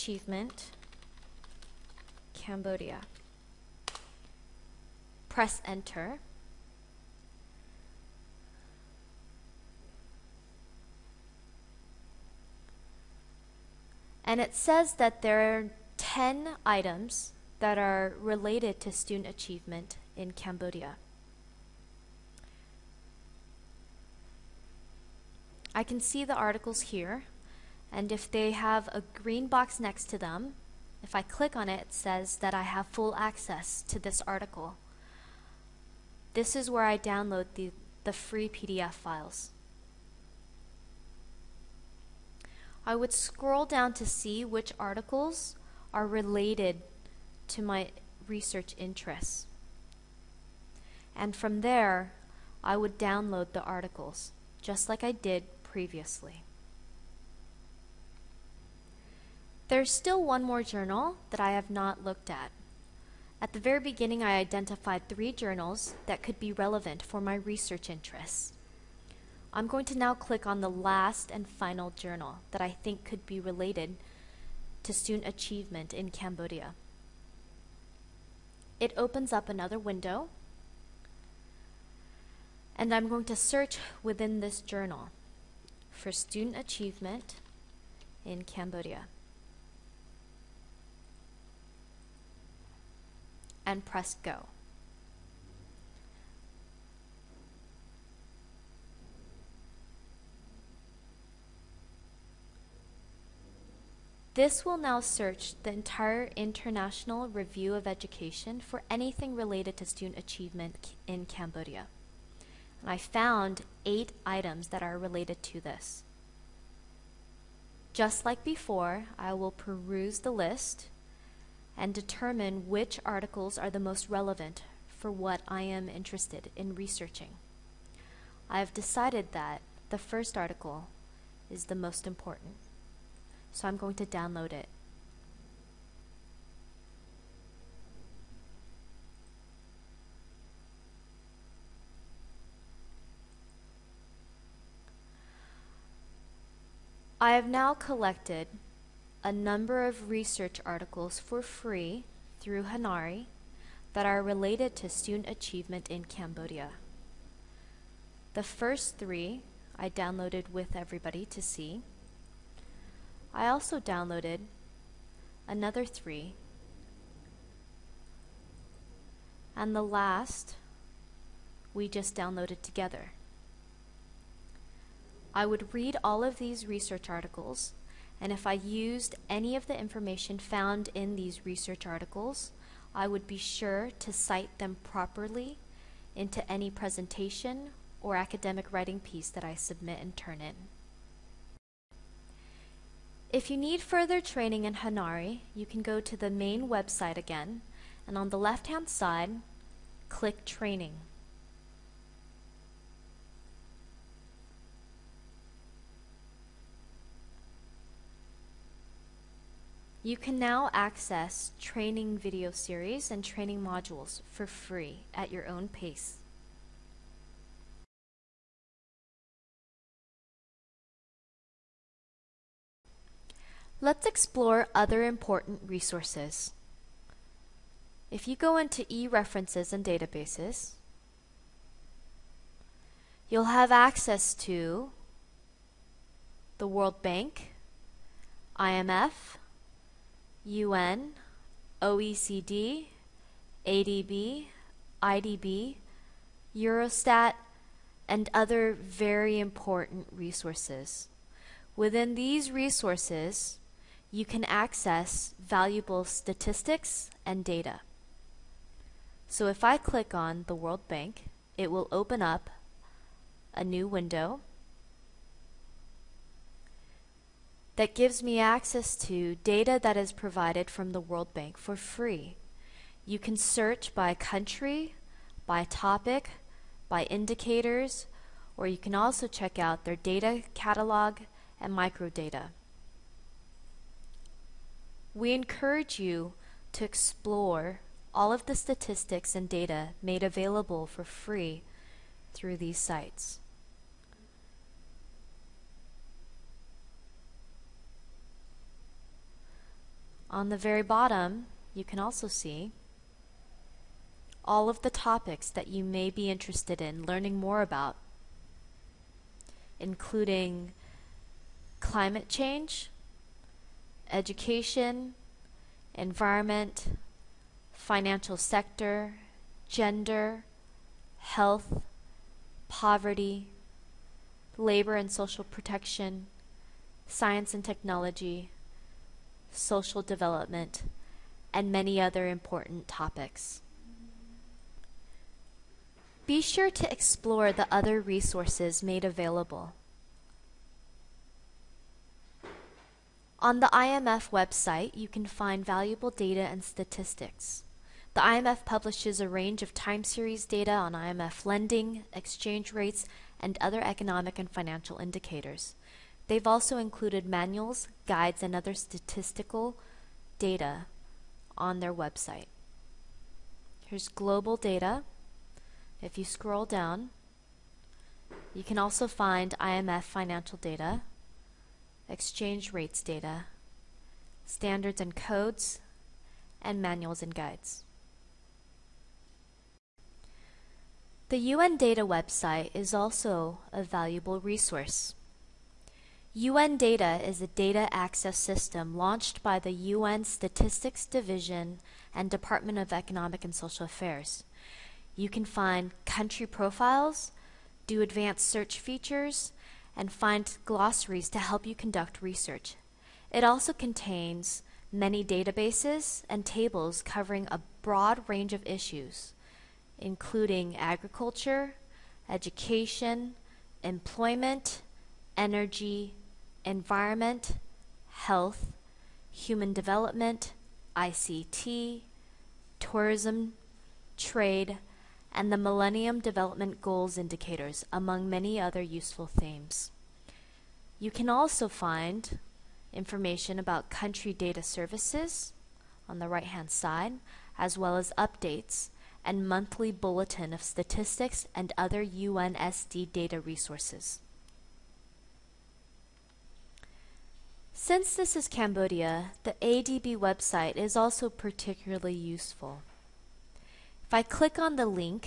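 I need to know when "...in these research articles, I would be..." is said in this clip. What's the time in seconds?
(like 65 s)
180 s.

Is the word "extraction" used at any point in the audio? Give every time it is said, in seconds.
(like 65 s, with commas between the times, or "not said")
not said.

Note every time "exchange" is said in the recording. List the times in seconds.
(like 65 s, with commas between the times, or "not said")
352 s, 372 s.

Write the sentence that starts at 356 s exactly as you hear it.
They've also included manuals, guides, and other statistical data on their website.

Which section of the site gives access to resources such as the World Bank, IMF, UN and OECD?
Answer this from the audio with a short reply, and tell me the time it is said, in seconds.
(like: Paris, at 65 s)
e-references and databases, at 228 s.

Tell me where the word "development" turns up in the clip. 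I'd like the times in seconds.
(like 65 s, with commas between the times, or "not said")
330 s, 419 s, 426 s.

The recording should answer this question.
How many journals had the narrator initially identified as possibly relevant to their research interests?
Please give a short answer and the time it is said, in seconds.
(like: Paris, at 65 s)
3, at 65 s.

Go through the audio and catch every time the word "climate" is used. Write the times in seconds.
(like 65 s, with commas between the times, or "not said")
311 s.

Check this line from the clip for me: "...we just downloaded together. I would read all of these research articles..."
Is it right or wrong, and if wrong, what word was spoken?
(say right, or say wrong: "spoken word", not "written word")
right.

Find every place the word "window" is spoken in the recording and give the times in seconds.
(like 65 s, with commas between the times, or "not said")
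79 s, 263 s.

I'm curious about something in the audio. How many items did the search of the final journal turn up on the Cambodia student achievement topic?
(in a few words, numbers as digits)
8.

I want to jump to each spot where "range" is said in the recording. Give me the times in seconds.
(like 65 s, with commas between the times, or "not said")
349 s, 408 s.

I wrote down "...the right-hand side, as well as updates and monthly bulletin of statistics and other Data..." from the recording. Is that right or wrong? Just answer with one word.
wrong.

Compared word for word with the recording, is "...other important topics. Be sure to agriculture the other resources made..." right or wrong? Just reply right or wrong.
wrong.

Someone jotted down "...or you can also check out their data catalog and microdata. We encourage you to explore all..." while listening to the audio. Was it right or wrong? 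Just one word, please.
right.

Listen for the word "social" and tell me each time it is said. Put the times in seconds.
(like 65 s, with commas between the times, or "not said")
325 s, 329 s, 393 s.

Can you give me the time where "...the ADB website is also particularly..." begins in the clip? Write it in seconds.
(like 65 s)
449 s.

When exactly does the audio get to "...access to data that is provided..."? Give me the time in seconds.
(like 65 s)
268 s.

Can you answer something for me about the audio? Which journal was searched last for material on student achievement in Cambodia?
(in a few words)
International Review of Education.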